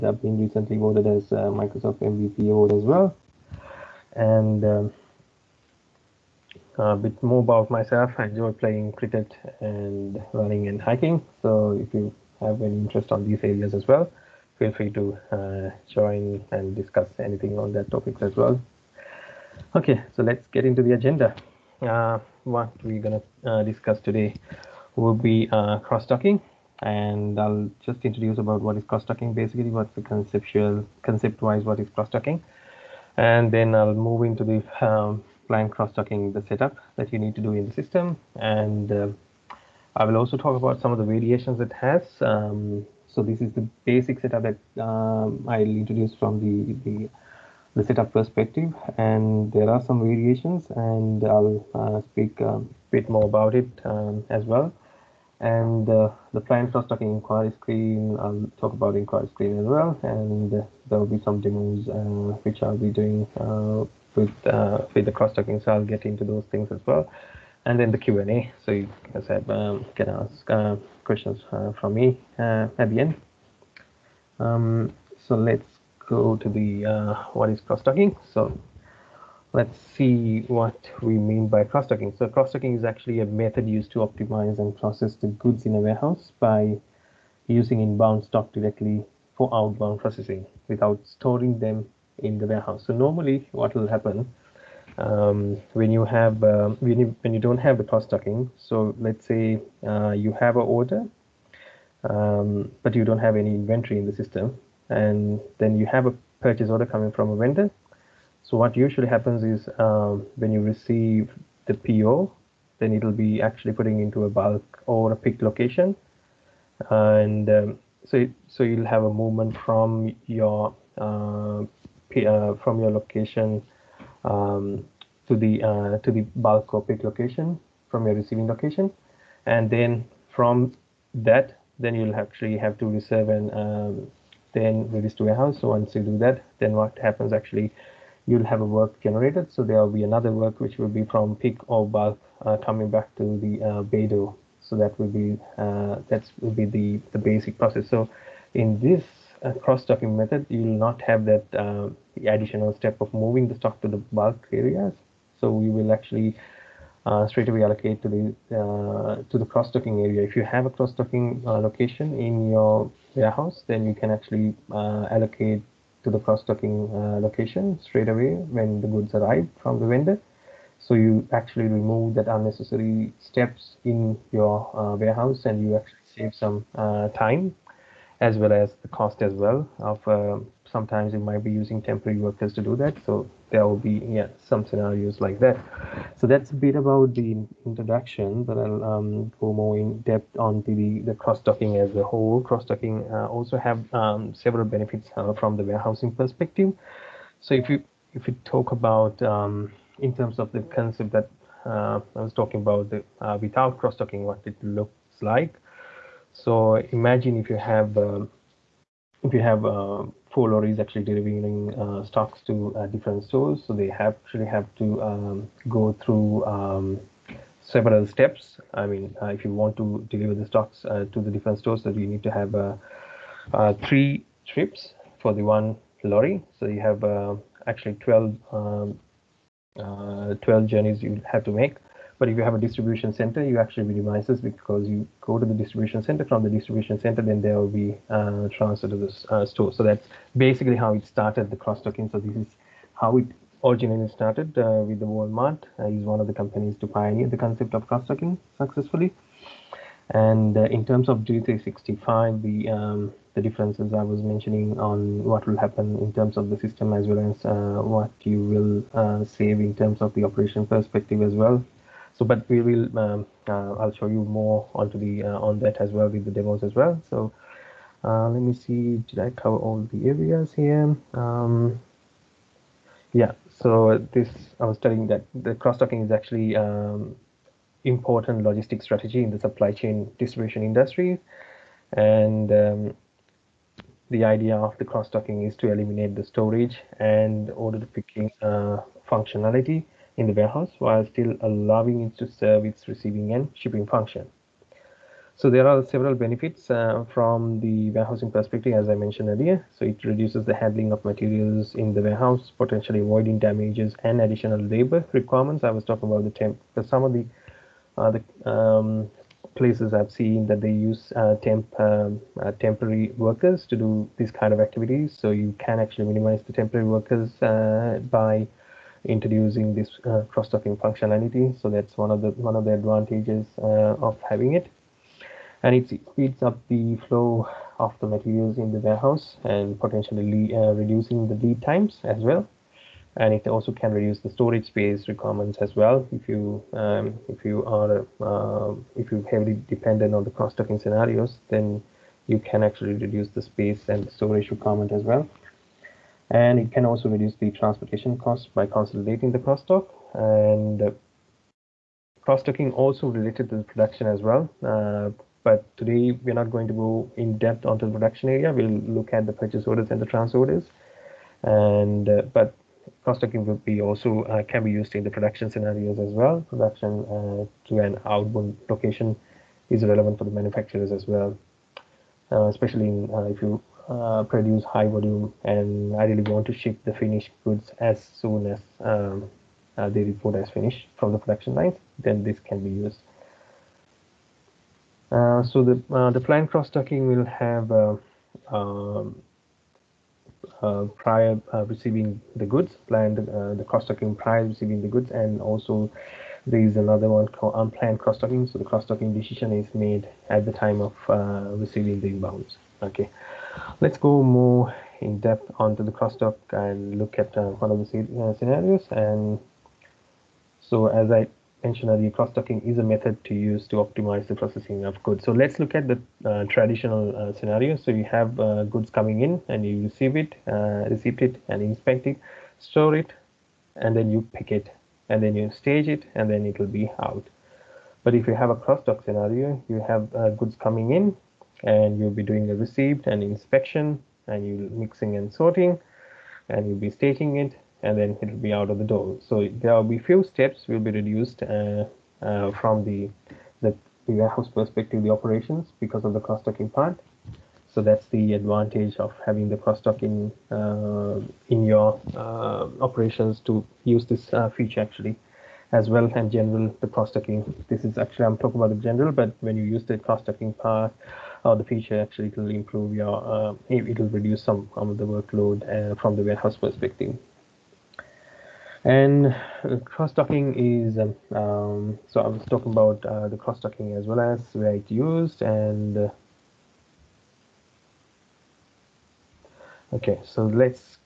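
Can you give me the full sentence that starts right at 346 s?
And it can also reduce the transportation cost by consolidating the cross-dock and cross-docking also related to the production as well.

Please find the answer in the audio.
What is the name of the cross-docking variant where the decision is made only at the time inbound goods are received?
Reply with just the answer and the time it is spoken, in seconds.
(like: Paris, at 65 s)
Unplanned cross-docking, at 397 s.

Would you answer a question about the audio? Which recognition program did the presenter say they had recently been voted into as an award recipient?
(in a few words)
Microsoft MVP.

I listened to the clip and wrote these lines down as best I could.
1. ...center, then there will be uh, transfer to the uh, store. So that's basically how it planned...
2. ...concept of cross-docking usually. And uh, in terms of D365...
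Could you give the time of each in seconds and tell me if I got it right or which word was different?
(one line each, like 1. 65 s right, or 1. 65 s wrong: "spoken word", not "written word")
1. 236 s wrong: "started", not "planned"
2. 247 s wrong: "successfully", not "usually".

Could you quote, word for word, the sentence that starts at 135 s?
So once you do that, then what happens actually, you'll have a work generated.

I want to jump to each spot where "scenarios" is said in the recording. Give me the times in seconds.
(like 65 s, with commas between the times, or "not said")
184 s, 340 s, 365 s, 408 s, 417 s, 429 s.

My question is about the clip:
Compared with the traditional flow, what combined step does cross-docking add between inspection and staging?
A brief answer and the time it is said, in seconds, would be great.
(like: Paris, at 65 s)
Mixing and sorting, at 434 s.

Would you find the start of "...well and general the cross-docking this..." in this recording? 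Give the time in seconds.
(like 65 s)
455 s.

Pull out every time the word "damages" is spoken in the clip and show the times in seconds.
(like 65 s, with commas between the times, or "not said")
303 s.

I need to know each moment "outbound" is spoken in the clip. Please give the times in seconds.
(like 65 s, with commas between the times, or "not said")
89 s, 368 s.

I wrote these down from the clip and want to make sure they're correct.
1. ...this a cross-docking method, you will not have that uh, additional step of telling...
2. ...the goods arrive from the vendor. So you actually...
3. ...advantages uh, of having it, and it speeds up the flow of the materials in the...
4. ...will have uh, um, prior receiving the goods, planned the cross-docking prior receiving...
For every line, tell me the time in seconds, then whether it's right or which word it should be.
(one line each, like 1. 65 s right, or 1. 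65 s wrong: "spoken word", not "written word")
1. 148 s wrong: "moving", not "telling"
2. 168 s right
3. 322 s right
4. 387 s right.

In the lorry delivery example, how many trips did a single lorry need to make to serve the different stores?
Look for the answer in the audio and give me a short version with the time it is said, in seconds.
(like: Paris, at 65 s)
3, at 223 s.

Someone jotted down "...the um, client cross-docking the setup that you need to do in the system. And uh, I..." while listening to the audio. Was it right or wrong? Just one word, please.
right.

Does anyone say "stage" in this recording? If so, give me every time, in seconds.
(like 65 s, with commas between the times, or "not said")
425 s.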